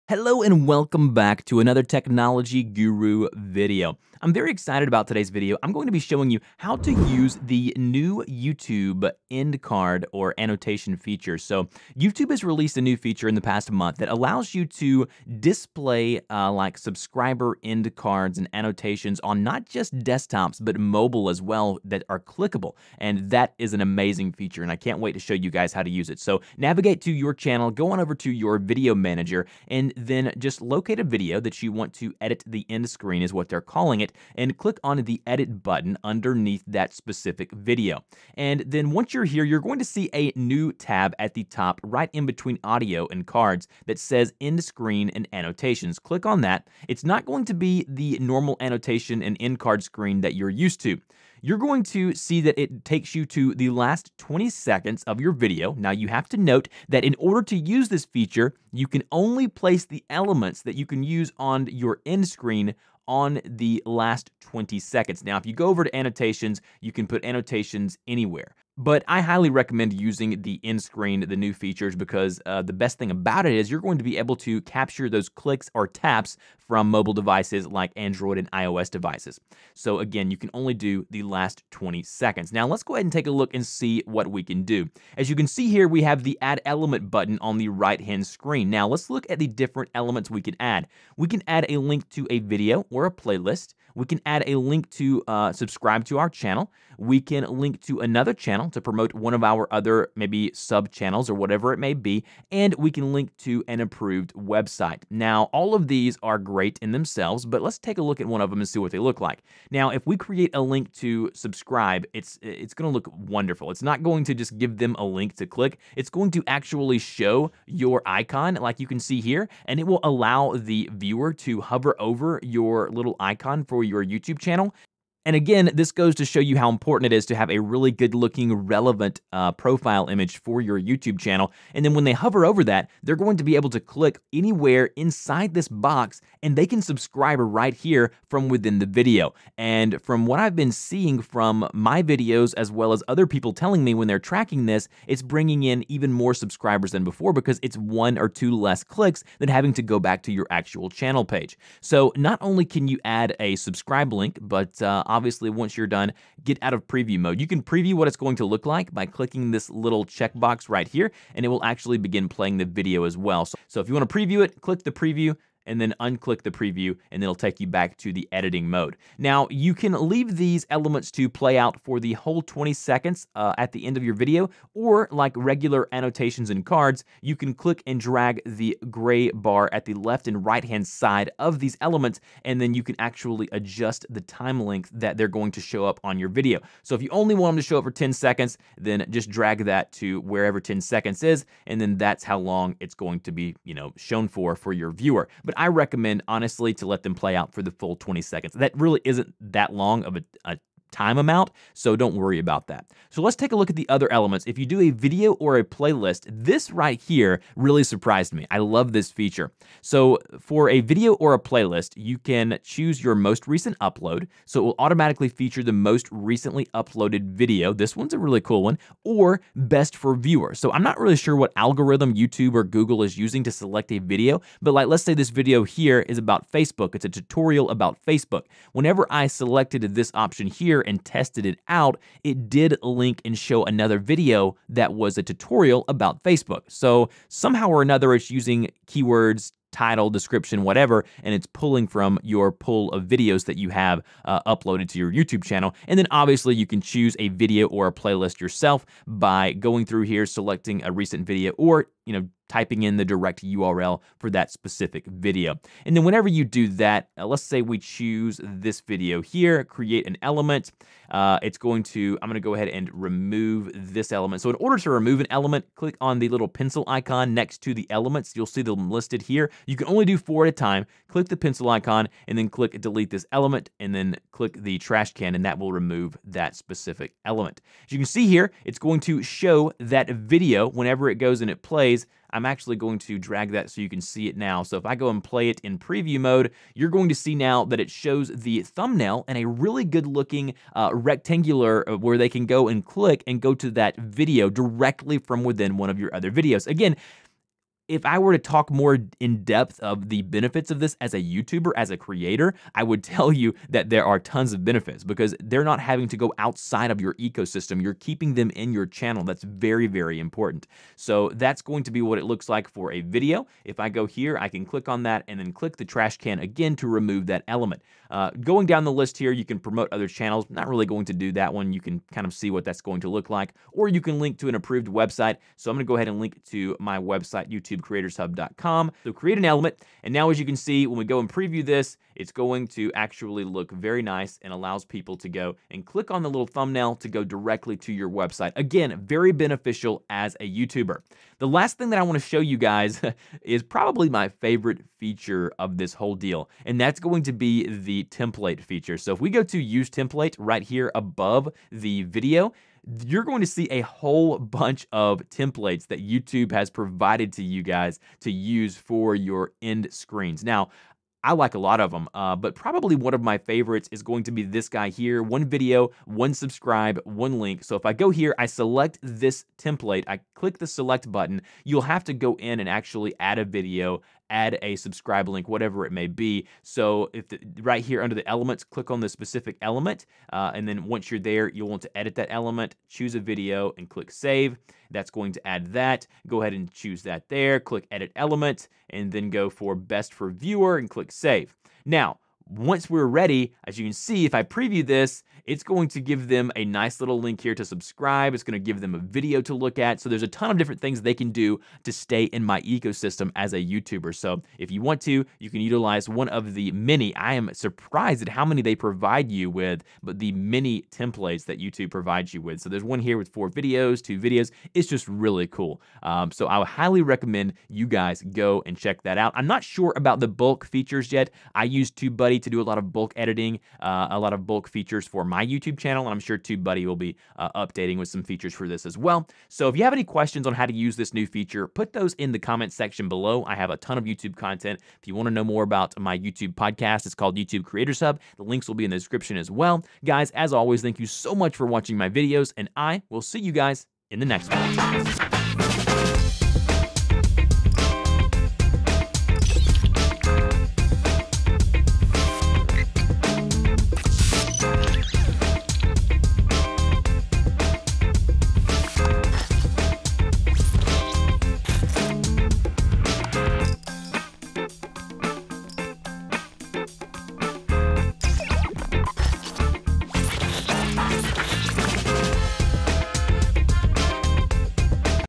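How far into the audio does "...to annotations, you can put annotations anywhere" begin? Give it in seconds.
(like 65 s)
65 s.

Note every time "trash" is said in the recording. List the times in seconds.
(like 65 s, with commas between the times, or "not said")
274 s, 315 s.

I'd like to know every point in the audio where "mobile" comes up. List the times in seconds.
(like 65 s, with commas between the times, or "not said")
20 s, 76 s.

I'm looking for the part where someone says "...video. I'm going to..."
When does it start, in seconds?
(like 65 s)
5 s.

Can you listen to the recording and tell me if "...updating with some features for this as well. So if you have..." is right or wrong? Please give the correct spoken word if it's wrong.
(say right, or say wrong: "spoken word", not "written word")
right.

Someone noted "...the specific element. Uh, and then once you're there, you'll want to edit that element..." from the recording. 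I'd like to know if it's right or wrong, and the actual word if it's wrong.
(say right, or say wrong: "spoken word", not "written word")
right.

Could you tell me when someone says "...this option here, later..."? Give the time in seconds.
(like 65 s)
229 s.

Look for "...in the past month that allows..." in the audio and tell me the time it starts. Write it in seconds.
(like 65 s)
13 s.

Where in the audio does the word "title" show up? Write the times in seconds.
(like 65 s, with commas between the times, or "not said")
239 s.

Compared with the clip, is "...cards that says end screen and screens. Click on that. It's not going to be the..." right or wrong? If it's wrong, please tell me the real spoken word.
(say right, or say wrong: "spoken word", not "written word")
wrong: "annotations", not "screens".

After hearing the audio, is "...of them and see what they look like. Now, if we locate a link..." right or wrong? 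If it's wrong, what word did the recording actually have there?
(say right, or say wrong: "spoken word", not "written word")
wrong: "create", not "locate".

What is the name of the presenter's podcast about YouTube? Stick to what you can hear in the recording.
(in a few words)
YouTube Creators Hub.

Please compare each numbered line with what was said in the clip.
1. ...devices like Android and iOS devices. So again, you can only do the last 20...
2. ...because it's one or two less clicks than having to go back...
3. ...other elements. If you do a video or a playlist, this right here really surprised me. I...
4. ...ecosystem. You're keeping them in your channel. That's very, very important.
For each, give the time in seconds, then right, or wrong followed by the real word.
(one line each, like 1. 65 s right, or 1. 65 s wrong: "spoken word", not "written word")
1. 77 s right
2. 147 s right
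3. 203 s right
4. 307 s right.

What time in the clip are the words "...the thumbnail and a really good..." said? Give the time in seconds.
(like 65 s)
288 s.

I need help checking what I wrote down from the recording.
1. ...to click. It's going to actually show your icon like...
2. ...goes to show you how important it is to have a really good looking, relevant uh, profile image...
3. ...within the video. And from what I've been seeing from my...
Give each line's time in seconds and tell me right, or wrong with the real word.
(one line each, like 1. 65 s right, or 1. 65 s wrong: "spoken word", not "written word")
1. 115 s right
2. 125 s right
3. 138 s right.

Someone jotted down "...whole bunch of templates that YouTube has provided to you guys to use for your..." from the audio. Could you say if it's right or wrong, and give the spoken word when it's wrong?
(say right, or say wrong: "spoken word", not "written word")
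right.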